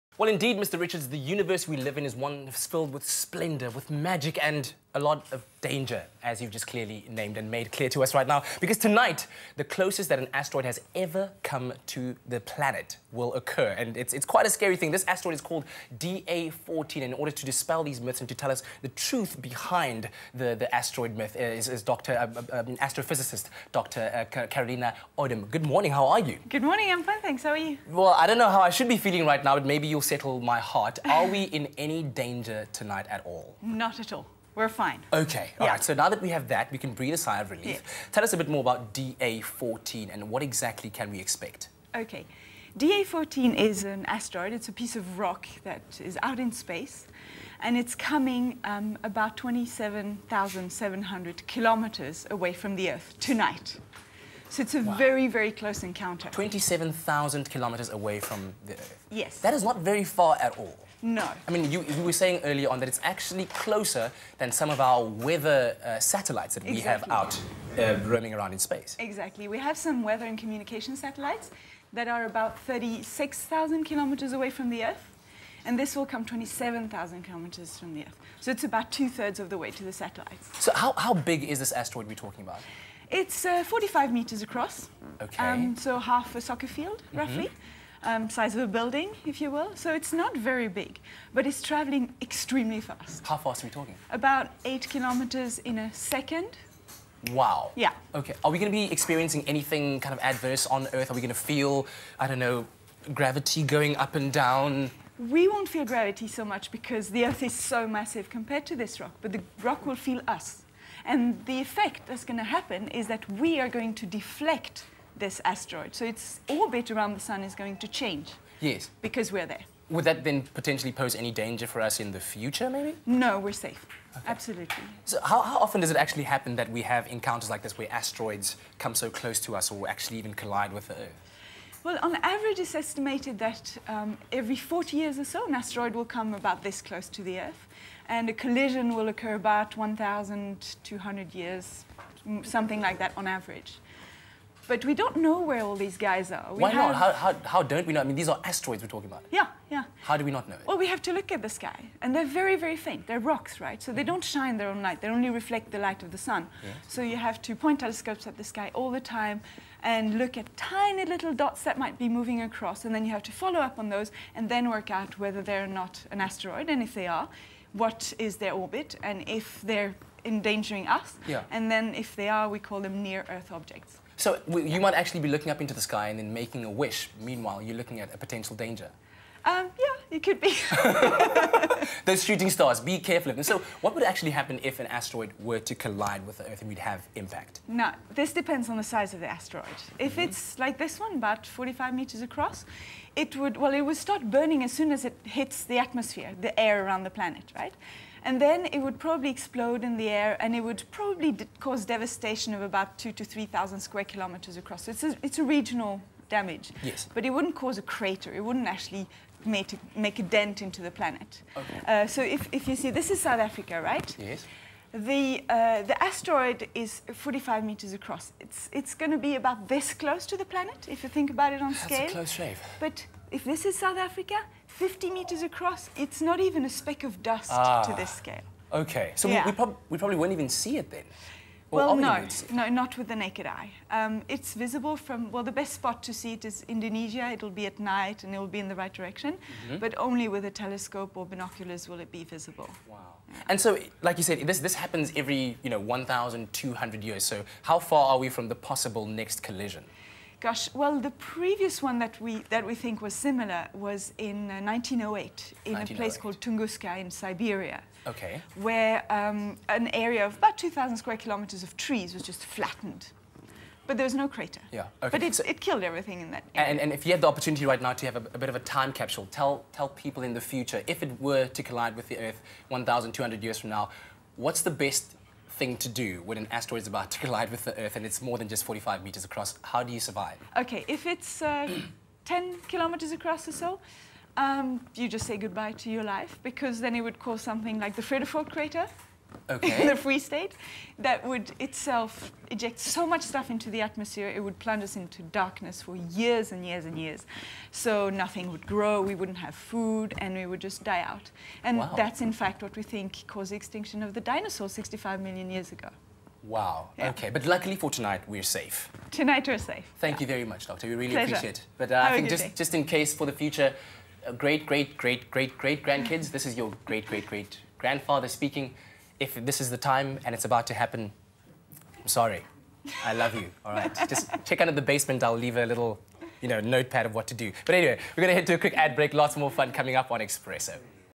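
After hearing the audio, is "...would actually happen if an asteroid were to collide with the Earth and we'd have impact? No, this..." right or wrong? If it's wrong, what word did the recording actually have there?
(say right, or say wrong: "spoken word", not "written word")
right.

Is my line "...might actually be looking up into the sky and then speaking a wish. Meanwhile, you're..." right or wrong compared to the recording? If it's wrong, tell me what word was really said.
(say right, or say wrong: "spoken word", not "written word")
wrong: "making", not "speaking".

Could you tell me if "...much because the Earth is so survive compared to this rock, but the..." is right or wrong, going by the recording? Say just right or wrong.
wrong.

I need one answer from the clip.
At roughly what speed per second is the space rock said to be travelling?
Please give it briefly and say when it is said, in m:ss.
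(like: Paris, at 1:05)
8 kilometers, at 1:34.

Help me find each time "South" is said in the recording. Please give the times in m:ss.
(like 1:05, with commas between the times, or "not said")
3:33, 3:43.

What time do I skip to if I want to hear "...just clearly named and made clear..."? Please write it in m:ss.
0:06.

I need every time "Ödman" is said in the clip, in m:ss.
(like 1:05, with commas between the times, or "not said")
0:25.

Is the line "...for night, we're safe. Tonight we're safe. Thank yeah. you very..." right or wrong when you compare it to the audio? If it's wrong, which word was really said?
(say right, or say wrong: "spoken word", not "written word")
wrong: "tonight", not "night".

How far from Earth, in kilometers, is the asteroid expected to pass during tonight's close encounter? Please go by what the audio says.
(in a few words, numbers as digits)
27,700 kilometers.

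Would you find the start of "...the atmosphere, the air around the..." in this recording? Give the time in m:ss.
3:15.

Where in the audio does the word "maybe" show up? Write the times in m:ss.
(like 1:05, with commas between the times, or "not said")
0:29, 2:02.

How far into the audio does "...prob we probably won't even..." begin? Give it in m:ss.
3:49.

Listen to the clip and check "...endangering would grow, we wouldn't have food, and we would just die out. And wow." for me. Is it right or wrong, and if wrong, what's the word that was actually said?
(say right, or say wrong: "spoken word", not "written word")
wrong: "nothing", not "endangering".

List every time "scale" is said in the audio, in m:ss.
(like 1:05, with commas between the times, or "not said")
3:41, 3:48.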